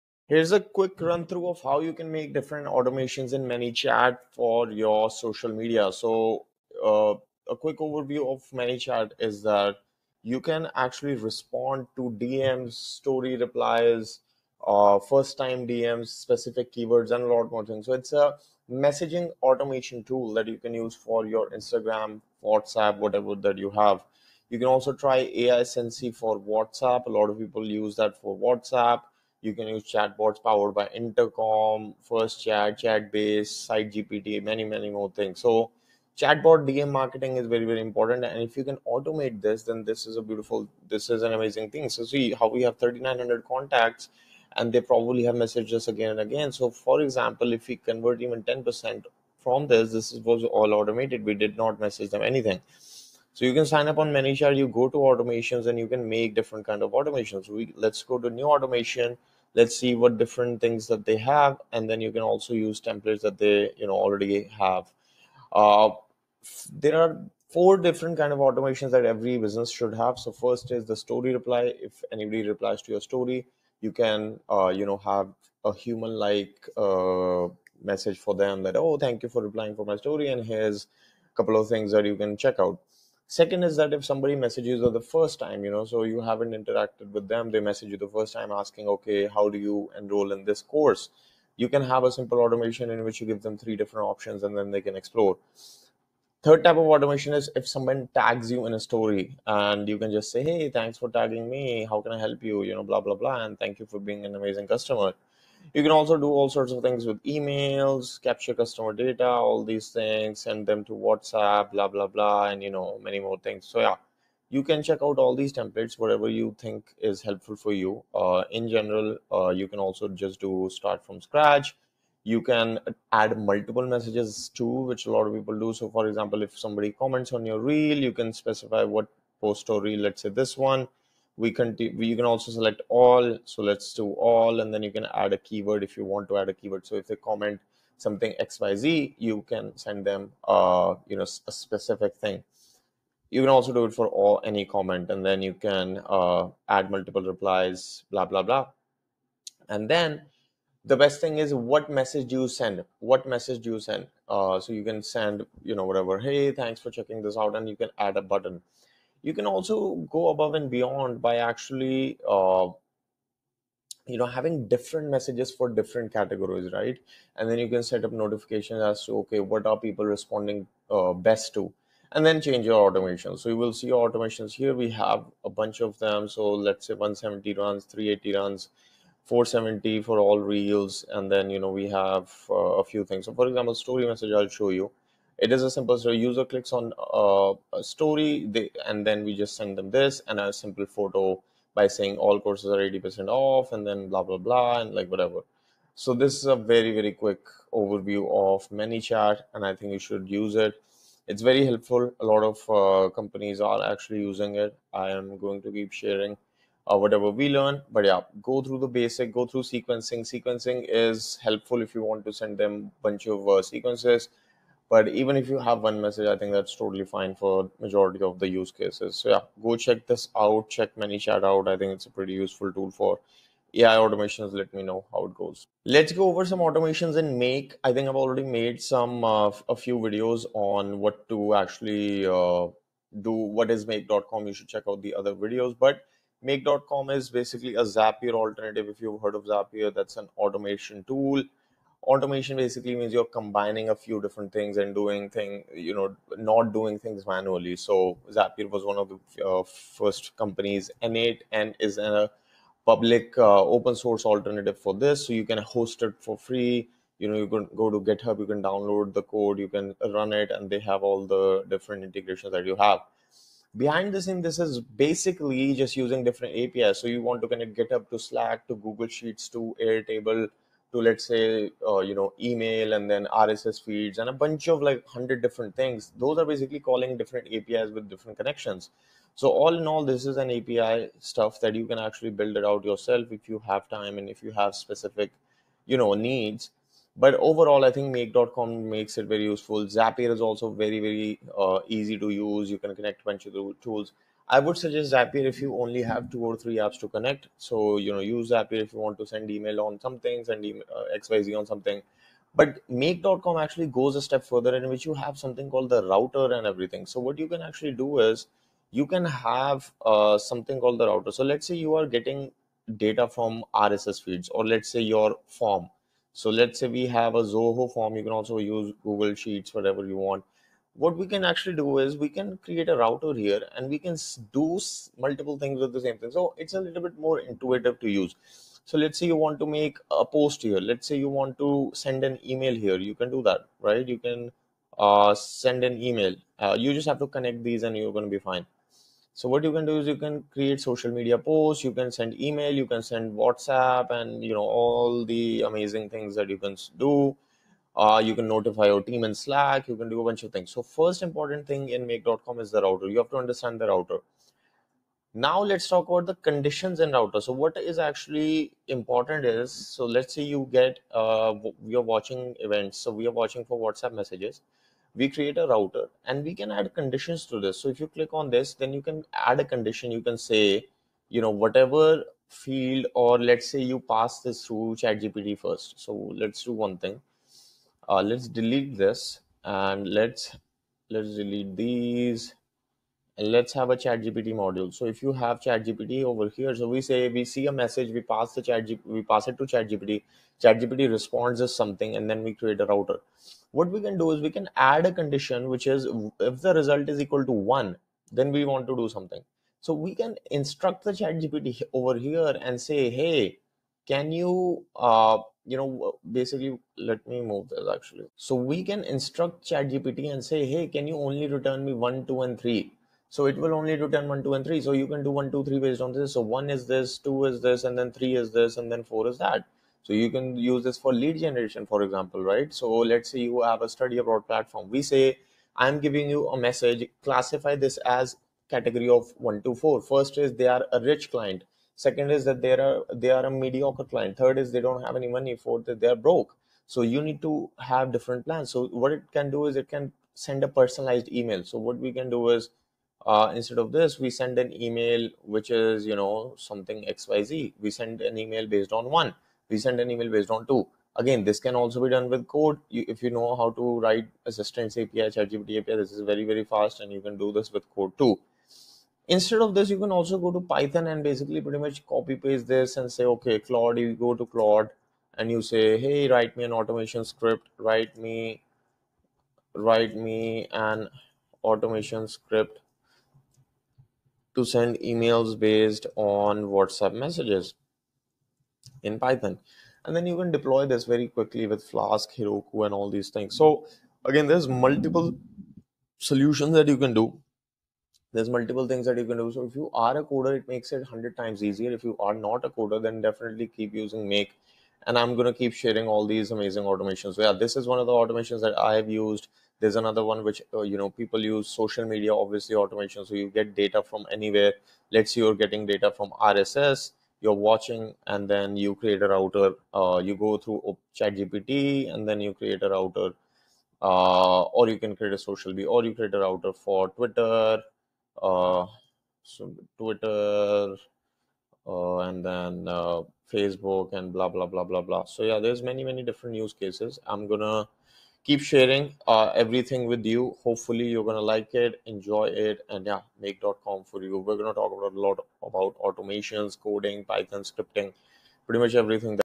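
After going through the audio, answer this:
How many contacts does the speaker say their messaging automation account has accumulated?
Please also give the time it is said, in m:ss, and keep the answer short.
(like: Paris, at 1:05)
3,900, at 0:42.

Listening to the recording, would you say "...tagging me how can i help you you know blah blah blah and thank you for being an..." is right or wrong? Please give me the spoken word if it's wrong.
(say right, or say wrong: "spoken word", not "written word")
right.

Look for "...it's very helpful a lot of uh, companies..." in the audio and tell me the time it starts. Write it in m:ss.
3:21.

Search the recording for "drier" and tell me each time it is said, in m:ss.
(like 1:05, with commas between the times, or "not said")
not said.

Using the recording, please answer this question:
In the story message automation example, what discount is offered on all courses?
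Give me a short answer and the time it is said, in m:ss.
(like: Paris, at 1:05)
80%, at 3:12.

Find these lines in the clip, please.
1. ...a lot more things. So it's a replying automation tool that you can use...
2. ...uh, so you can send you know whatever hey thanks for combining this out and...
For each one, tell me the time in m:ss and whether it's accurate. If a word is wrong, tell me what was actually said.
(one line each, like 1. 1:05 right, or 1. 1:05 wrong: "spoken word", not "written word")
1. 0:17 wrong: "messaging", not "replying"
2. 2:34 wrong: "checking", not "combining".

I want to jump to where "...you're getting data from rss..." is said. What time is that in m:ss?
8:25.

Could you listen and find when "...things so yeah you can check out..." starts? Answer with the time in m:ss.
1:53.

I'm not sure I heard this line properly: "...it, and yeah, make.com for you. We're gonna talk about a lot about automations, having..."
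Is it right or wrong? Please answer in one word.
wrong.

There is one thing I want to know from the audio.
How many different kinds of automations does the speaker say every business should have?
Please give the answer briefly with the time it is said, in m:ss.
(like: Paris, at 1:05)
4, at 1:07.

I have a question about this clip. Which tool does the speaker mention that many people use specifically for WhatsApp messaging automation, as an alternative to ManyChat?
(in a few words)
AiSensy.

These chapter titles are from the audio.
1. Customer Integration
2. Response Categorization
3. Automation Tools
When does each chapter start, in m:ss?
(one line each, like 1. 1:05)
1. 1:18
2. 2:19
3. 3:32.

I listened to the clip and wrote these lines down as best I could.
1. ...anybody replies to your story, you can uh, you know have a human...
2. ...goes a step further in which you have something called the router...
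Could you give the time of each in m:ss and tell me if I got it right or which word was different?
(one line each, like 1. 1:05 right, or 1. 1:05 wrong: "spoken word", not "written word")
1. 1:12 right
2. 5:03 right.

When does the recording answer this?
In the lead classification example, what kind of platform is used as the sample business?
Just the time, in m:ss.
7:03.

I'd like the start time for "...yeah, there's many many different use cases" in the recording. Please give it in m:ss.
8:45.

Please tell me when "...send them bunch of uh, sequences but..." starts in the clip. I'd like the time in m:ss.
3:32.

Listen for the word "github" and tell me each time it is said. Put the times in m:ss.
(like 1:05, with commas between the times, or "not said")
4:18, 4:27.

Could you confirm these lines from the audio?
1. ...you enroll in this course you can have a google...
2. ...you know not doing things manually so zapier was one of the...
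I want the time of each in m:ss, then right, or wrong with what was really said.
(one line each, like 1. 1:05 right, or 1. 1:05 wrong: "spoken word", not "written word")
1. 1:29 wrong: "simple", not "google"
2. 4:05 right.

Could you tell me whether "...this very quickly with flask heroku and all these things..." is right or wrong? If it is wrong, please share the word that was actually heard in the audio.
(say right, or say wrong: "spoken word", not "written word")
right.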